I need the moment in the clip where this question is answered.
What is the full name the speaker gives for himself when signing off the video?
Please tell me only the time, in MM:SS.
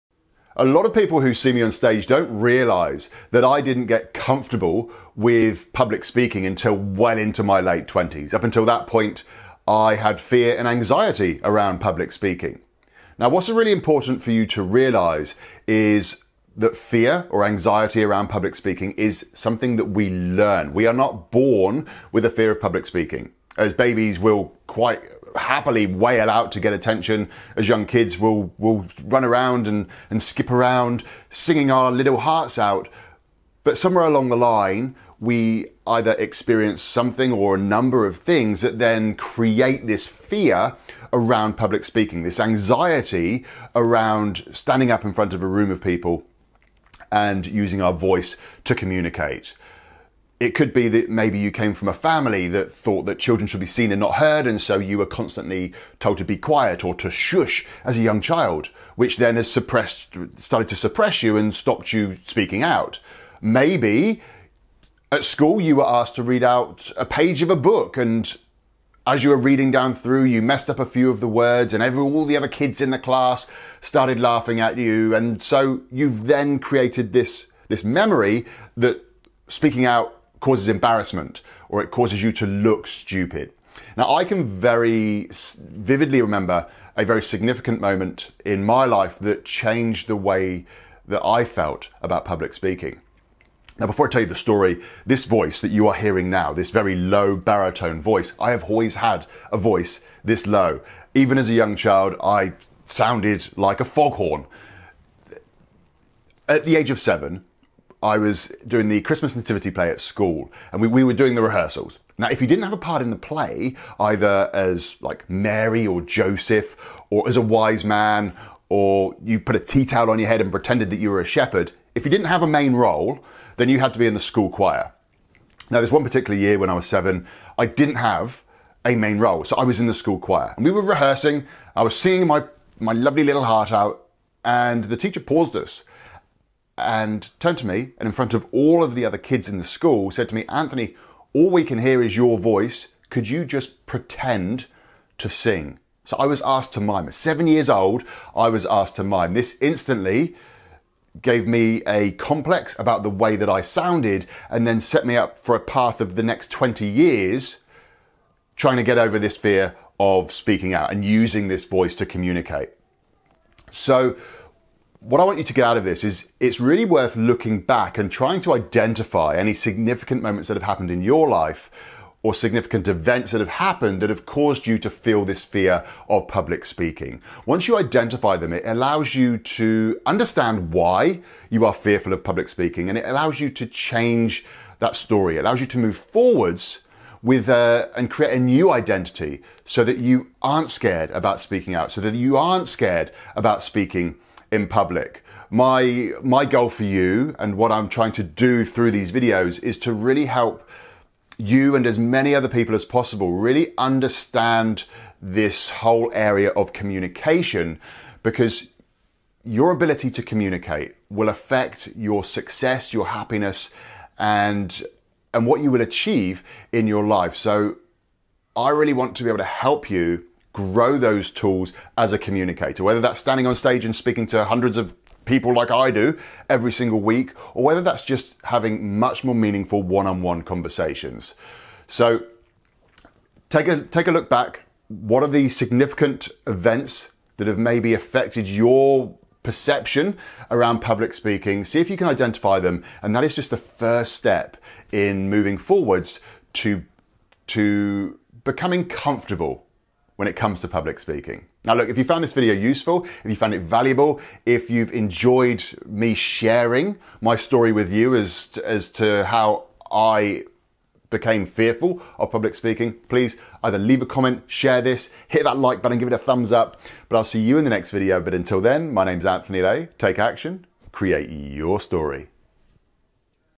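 04:29.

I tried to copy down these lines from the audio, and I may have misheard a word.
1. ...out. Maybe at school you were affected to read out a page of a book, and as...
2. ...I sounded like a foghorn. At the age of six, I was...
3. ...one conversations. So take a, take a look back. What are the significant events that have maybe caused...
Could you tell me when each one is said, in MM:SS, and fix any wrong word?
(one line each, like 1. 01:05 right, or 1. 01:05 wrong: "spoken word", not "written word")
1. 01:02 wrong: "asked", not "affected"
2. 01:42 wrong: "seven", not "six"
3. 03:50 wrong: "affected", not "caused".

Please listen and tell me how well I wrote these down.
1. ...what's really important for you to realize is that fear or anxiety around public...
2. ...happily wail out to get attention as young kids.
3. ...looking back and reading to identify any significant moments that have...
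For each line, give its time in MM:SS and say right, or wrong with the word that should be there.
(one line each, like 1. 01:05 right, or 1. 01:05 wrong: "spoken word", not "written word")
1. 00:13 right
2. 00:25 right
3. 02:47 wrong: "trying", not "reading".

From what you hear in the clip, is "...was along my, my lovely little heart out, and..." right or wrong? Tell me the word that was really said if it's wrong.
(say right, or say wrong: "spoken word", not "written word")
wrong: "singing", not "along".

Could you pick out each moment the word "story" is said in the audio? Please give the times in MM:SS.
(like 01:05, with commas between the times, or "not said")
01:34, 03:04, 04:17, 04:31.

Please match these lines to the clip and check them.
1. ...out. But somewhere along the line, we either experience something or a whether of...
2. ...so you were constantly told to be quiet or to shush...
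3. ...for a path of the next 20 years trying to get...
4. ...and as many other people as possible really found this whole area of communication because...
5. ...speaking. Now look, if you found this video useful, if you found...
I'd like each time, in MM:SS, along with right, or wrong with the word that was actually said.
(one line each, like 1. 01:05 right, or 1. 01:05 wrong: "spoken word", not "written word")
1. 00:32 wrong: "number", not "whether"
2. 00:54 right
3. 02:35 right
4. 03:21 wrong: "understand", not "found"
5. 04:10 right.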